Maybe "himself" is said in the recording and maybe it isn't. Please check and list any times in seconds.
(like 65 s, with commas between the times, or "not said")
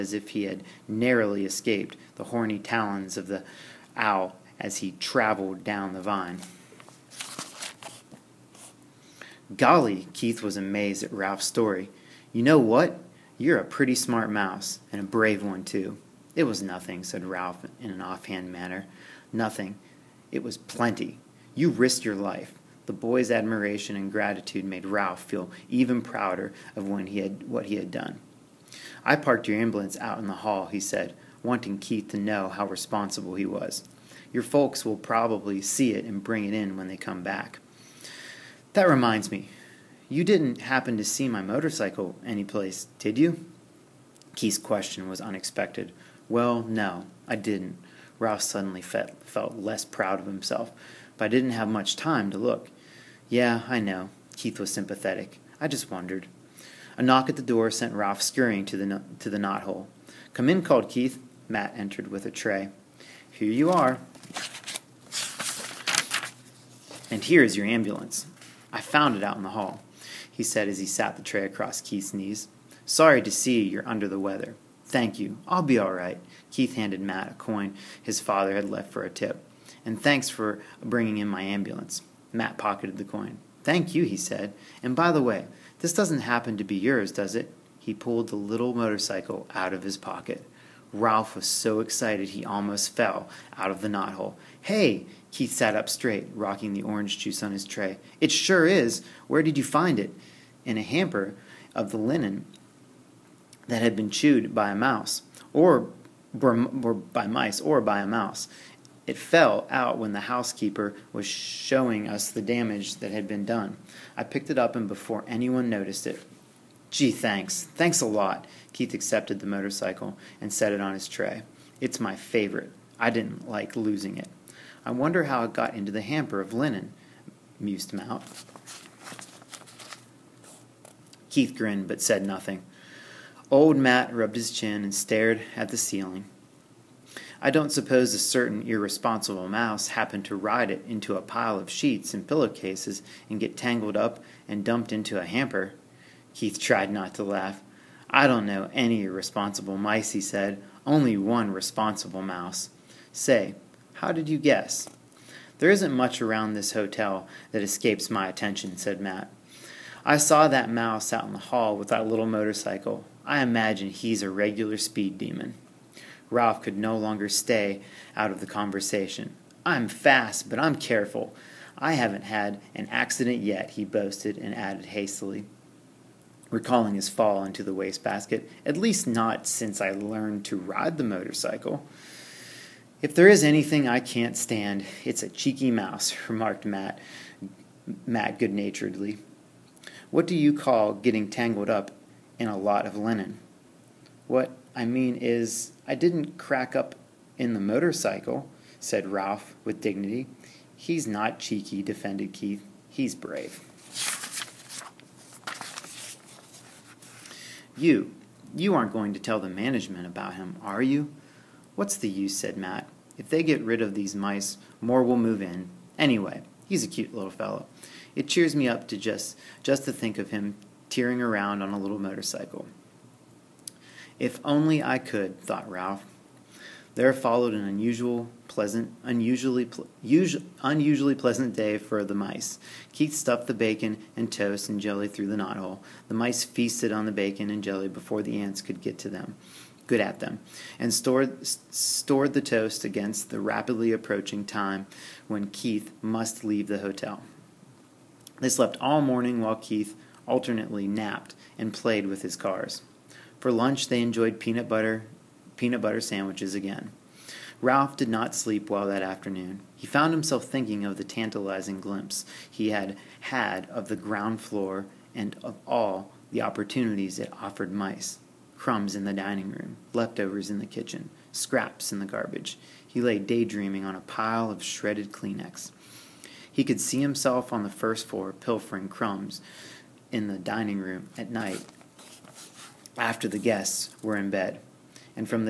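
50 s, 260 s, 277 s.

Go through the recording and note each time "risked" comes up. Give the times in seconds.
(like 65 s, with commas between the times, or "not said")
21 s.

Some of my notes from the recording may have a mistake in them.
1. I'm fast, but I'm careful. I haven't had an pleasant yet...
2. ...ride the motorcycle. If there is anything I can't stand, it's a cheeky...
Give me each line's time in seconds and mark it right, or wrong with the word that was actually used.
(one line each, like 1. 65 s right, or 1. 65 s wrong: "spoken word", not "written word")
1. 169 s wrong: "accident", not "pleasant"
2. 180 s right.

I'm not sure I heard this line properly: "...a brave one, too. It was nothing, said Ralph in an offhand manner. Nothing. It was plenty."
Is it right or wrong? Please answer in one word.
right.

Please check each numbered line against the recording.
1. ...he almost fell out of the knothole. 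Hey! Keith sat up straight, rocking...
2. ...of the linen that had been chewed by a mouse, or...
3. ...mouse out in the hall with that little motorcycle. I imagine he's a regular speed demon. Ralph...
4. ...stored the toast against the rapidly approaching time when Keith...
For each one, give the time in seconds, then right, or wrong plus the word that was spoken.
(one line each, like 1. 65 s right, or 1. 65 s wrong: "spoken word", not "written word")
1. 92 s right
2. 101 s right
3. 160 s right
4. 241 s right.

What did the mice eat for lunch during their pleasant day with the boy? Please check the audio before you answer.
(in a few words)
Peanut butter sandwiches.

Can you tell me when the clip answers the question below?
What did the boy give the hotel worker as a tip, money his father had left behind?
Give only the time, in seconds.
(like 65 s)
77 s.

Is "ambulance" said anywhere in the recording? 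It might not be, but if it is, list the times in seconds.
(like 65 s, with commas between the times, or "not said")
29 s, 67 s, 81 s.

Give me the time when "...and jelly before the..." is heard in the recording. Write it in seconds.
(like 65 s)
237 s.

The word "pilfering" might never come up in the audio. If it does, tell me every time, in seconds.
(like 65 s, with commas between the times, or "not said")
278 s.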